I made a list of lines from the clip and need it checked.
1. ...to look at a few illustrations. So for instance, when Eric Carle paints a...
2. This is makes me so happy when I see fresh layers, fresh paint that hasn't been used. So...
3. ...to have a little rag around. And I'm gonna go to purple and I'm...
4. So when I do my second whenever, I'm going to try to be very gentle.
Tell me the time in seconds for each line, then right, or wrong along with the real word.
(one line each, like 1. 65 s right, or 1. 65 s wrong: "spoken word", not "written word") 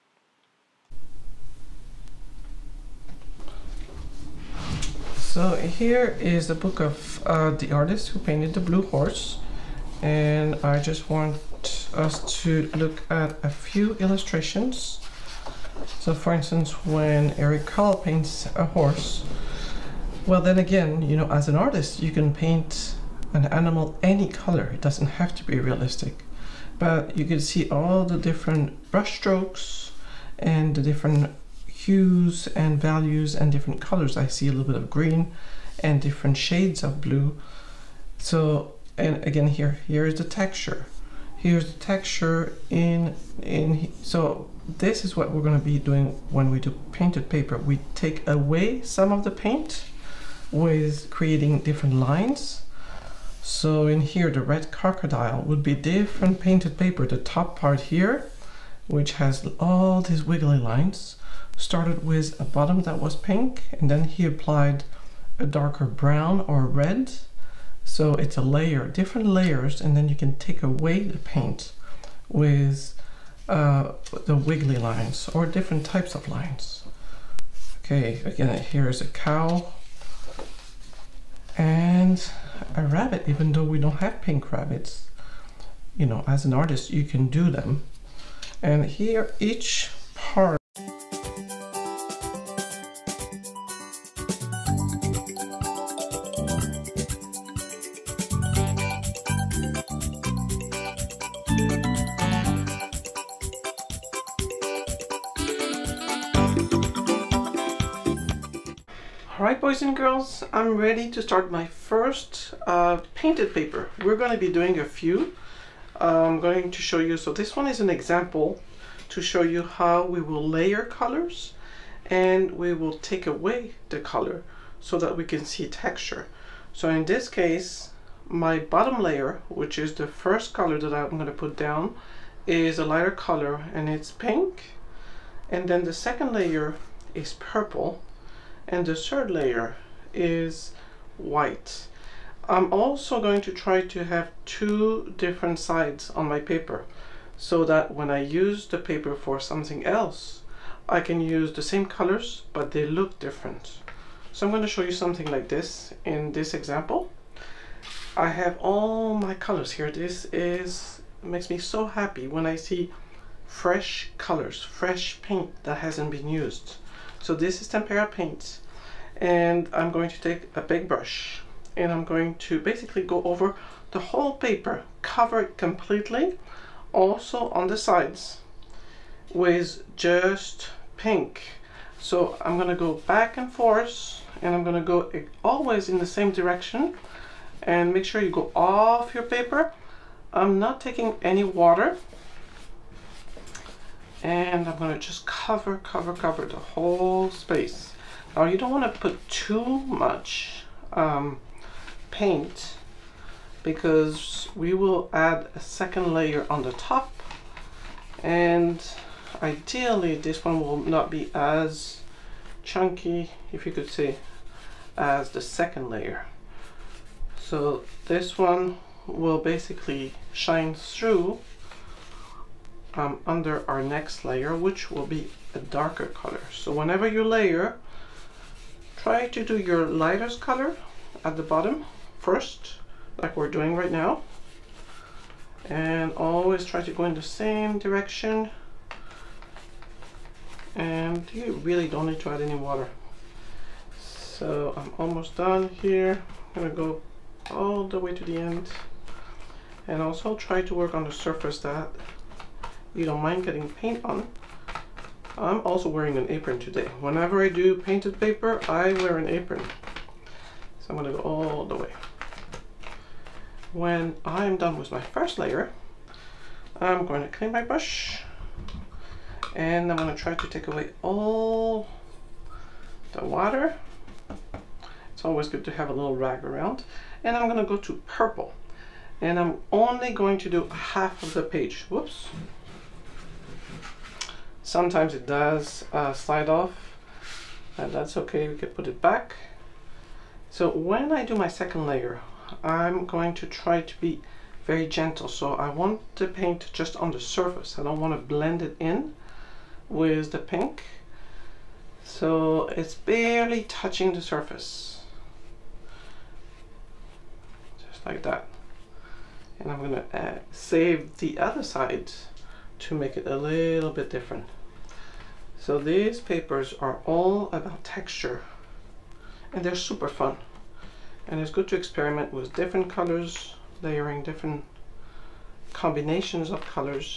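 1. 12 s right
2. 159 s wrong: "colors", not "layers"
3. 275 s right
4. 290 s wrong: "layer", not "whenever".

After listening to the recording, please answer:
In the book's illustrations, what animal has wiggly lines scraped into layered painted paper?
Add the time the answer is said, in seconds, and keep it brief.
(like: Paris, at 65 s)
crocodile, at 54 s.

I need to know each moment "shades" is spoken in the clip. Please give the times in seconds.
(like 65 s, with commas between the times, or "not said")
36 s.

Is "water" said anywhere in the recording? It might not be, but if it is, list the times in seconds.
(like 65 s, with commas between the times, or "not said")
191 s, 242 s, 273 s.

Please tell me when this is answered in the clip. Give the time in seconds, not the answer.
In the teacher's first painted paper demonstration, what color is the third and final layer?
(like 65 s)
141 s.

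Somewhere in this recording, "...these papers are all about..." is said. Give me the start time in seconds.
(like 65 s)
315 s.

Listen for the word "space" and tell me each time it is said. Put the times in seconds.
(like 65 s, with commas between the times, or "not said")
197 s.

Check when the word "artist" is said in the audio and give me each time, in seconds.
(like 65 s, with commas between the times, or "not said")
7 s, 21 s, 86 s.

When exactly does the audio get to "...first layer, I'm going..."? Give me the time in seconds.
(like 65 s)
264 s.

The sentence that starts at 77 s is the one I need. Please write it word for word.
Okay, again, here is a cow and a rabbit, even though we don't have pink rabbits.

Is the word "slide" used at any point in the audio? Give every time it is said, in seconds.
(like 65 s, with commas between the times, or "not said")
286 s.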